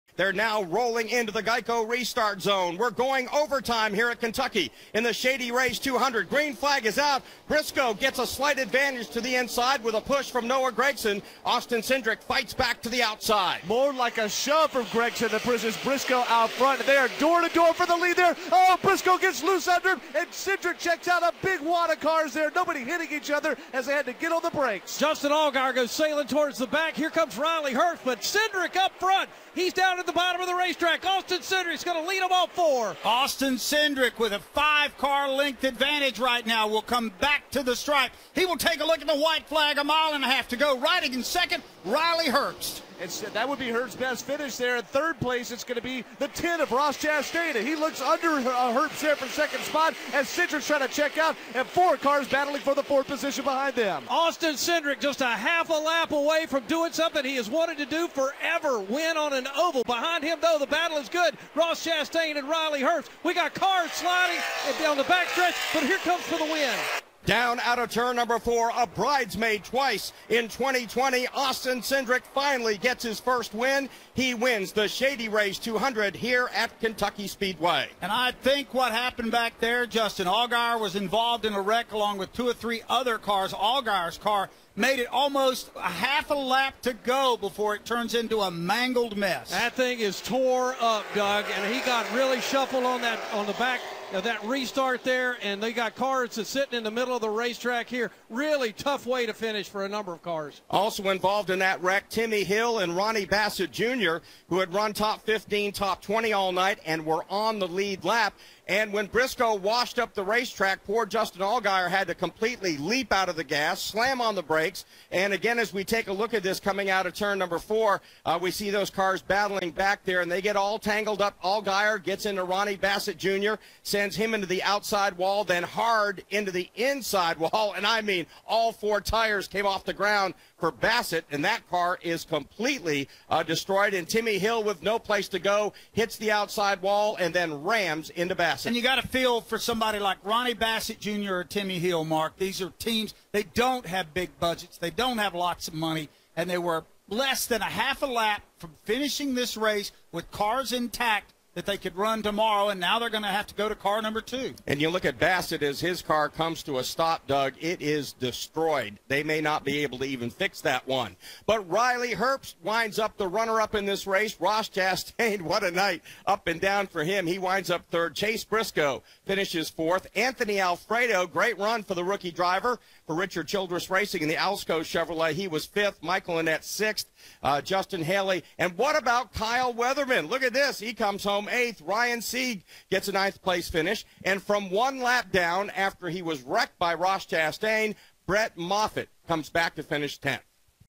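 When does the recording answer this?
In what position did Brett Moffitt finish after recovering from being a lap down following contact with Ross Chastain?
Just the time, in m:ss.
3:10.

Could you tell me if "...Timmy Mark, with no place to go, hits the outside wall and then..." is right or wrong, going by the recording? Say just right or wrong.
wrong.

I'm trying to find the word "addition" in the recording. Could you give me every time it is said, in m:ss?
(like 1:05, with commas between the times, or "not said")
not said.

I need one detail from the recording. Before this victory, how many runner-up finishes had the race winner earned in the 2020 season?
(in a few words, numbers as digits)
twice.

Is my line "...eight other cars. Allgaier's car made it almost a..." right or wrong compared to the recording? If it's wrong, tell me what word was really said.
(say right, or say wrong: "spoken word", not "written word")
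wrong: "three", not "eight".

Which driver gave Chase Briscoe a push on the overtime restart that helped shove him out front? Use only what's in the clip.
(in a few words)
Noah Gragson.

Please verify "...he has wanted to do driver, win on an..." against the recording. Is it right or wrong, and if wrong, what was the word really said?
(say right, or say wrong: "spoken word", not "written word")
wrong: "forever", not "driver".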